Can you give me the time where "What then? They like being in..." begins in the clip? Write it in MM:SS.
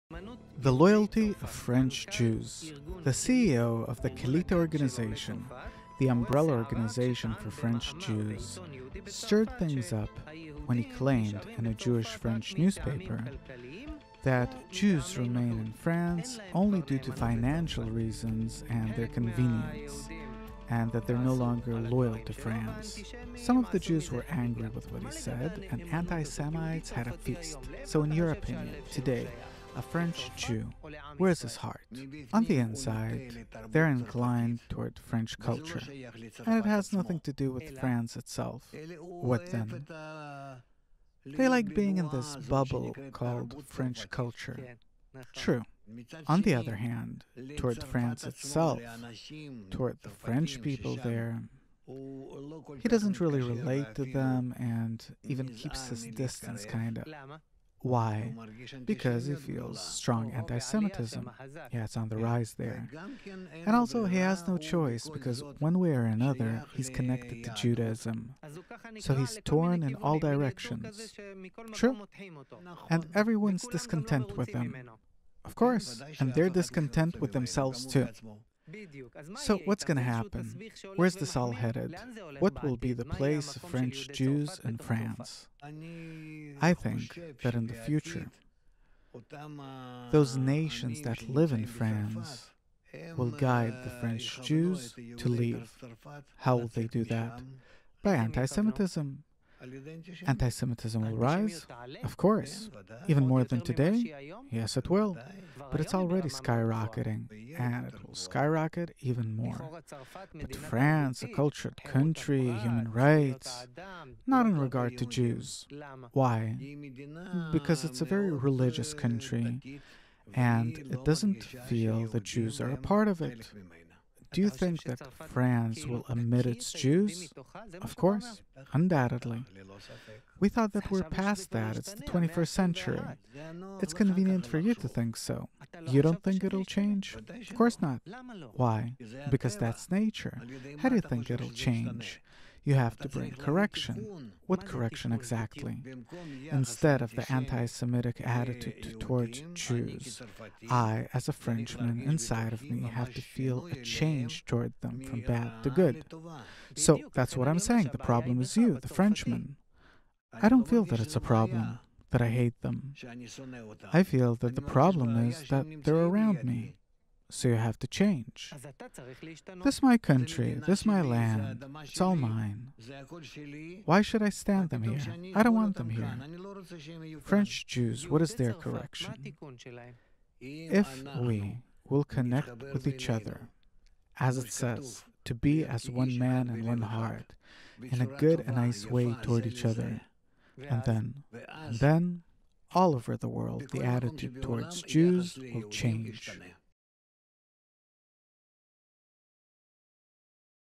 00:38.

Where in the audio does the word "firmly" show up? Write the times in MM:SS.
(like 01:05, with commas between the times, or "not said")
not said.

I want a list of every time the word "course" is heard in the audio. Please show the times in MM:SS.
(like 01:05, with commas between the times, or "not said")
01:15, 01:42, 02:07, 02:17.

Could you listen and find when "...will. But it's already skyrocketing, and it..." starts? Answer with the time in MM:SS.
01:44.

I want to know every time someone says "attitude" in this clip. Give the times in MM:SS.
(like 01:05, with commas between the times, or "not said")
02:28, 03:13.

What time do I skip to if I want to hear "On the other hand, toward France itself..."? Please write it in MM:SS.
00:46.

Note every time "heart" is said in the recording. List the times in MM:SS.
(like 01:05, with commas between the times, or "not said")
00:31, 03:06.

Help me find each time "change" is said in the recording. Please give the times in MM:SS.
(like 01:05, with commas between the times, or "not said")
02:16, 02:21, 02:33, 02:47, 03:15.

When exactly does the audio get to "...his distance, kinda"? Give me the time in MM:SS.
00:55.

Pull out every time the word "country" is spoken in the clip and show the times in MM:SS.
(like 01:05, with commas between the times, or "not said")
01:51, 01:58, 02:49.